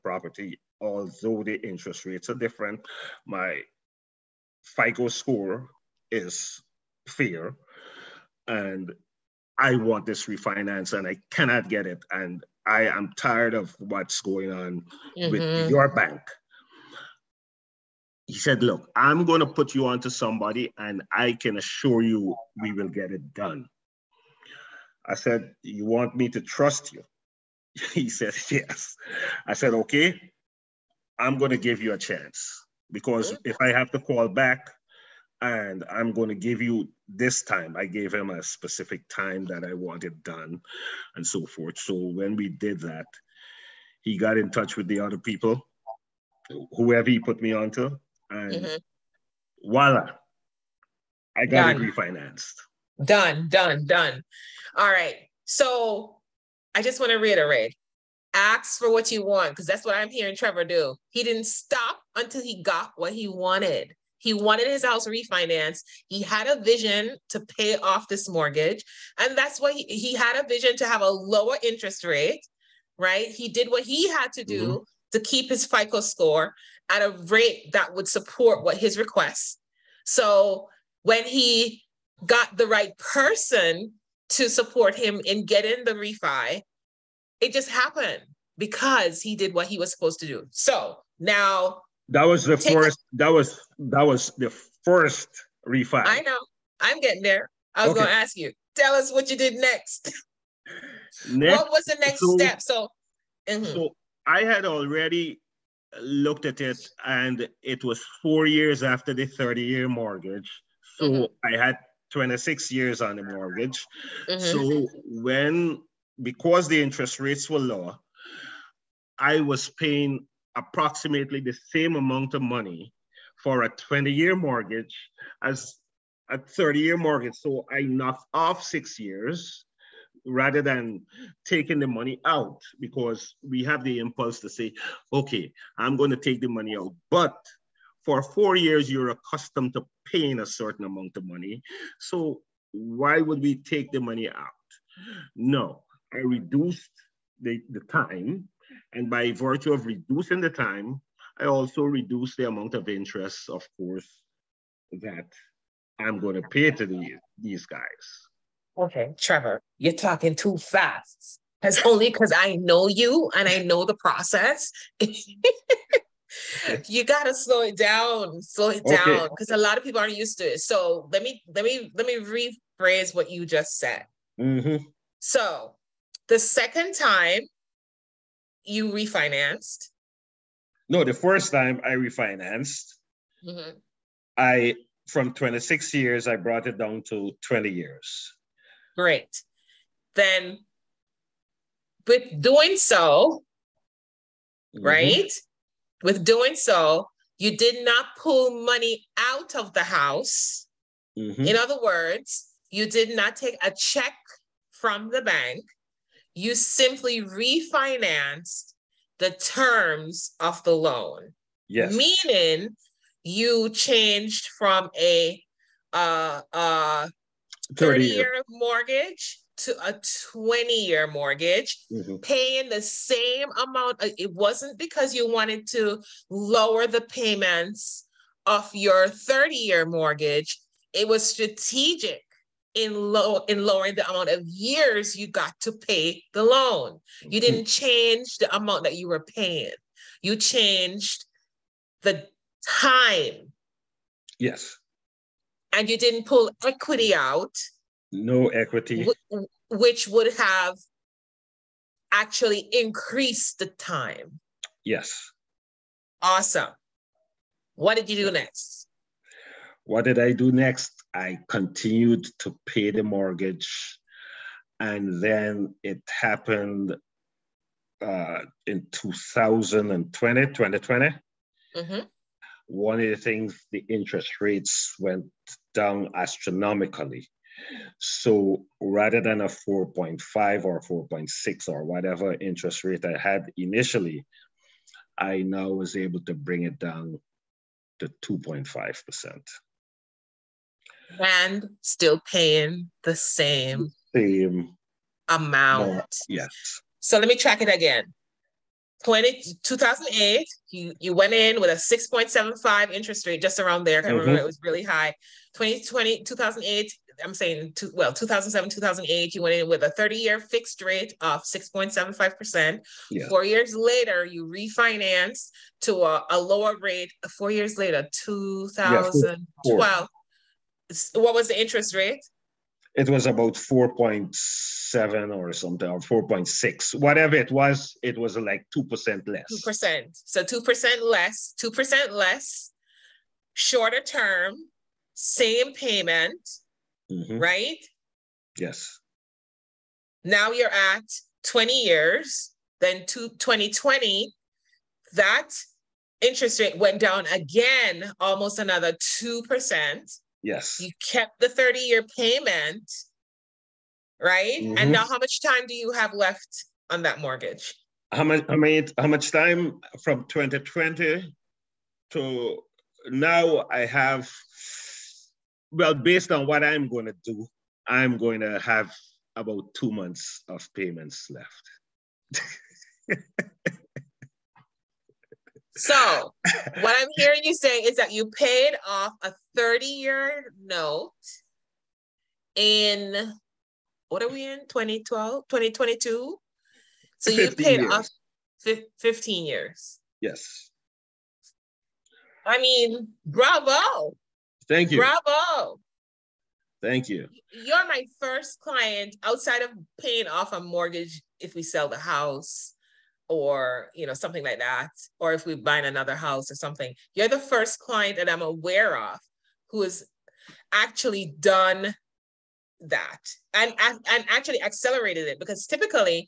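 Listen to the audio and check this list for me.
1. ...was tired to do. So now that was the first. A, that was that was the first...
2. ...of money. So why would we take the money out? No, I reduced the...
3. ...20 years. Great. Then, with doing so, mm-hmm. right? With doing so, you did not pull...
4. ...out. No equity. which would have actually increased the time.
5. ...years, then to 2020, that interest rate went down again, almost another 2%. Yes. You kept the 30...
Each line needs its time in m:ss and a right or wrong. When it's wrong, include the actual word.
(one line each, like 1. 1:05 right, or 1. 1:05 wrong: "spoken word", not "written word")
1. 1:29 wrong: "supposed", not "tired"
2. 2:21 right
3. 3:07 right
4. 4:07 right
5. 5:41 right.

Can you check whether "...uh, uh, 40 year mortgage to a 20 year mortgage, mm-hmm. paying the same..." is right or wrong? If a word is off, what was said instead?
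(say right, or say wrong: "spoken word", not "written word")
wrong: "30", not "40".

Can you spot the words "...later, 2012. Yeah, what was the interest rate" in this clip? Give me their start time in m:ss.
5:17.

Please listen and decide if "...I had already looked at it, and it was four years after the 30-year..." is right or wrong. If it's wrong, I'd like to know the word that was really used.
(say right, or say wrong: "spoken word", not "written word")
right.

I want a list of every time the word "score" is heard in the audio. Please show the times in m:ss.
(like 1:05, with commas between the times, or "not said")
0:05, 1:15.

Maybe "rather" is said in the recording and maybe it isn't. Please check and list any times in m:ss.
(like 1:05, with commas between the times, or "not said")
2:10, 4:38.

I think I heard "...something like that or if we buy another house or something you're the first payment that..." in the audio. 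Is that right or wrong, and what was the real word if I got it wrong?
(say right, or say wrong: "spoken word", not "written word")
wrong: "client", not "payment".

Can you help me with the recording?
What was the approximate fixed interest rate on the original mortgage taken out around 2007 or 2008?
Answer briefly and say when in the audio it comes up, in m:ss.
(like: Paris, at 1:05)
6.75%, at 5:01.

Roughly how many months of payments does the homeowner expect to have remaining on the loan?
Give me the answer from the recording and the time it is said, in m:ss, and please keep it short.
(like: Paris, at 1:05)
2 months, at 6:09.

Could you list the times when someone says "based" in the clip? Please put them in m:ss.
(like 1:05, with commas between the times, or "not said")
6:05.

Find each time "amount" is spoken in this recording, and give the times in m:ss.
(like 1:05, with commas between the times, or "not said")
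2:01, 2:20, 2:32, 3:43, 3:54, 3:58, 4:55.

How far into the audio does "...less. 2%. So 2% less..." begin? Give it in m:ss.
5:29.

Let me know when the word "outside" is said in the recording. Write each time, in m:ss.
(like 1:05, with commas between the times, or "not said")
6:39.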